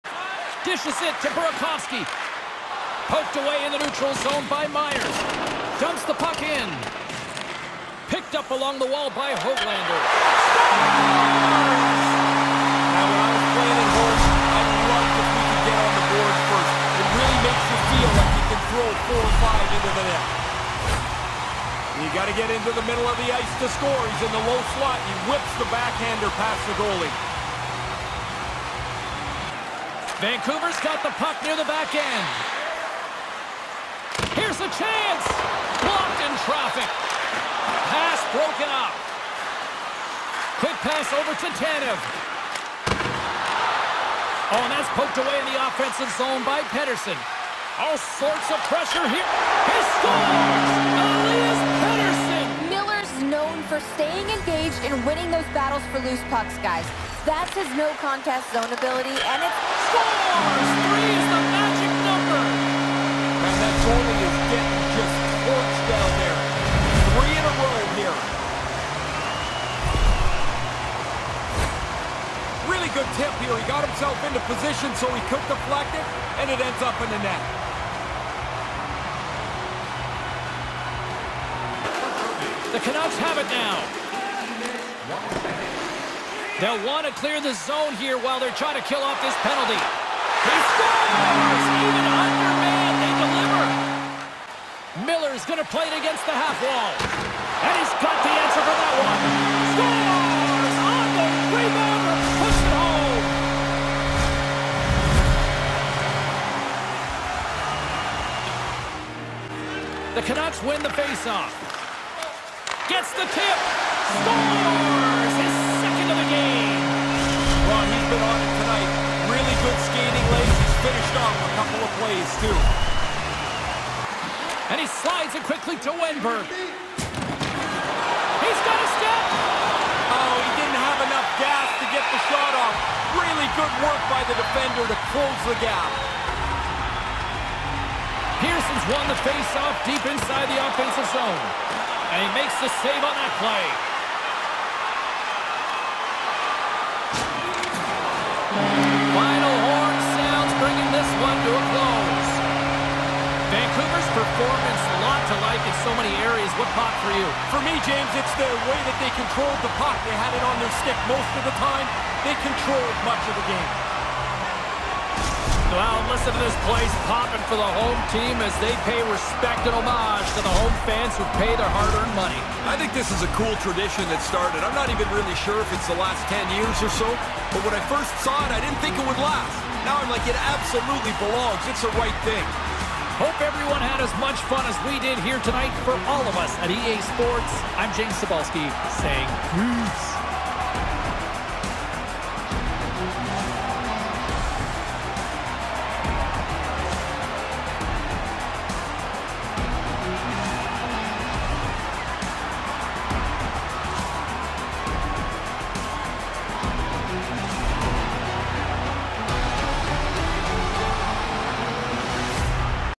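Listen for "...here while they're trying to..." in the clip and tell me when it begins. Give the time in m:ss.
1:27.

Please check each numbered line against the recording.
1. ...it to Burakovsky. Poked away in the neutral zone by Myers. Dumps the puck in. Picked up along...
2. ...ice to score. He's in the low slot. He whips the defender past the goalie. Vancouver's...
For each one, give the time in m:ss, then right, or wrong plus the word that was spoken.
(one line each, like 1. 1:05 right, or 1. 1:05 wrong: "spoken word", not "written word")
1. 0:01 right
2. 0:23 wrong: "backhander", not "defender".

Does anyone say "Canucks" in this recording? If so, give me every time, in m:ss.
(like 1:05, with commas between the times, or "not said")
1:22, 1:50.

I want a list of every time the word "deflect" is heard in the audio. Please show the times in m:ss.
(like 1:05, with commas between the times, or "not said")
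1:15.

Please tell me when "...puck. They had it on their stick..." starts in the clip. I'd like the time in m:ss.
2:39.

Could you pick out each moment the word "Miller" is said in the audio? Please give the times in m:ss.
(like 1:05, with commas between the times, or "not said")
0:52, 1:35.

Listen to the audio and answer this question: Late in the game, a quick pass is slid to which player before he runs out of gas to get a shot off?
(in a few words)
Wennberg.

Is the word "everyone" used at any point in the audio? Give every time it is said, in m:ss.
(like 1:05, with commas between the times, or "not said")
3:03.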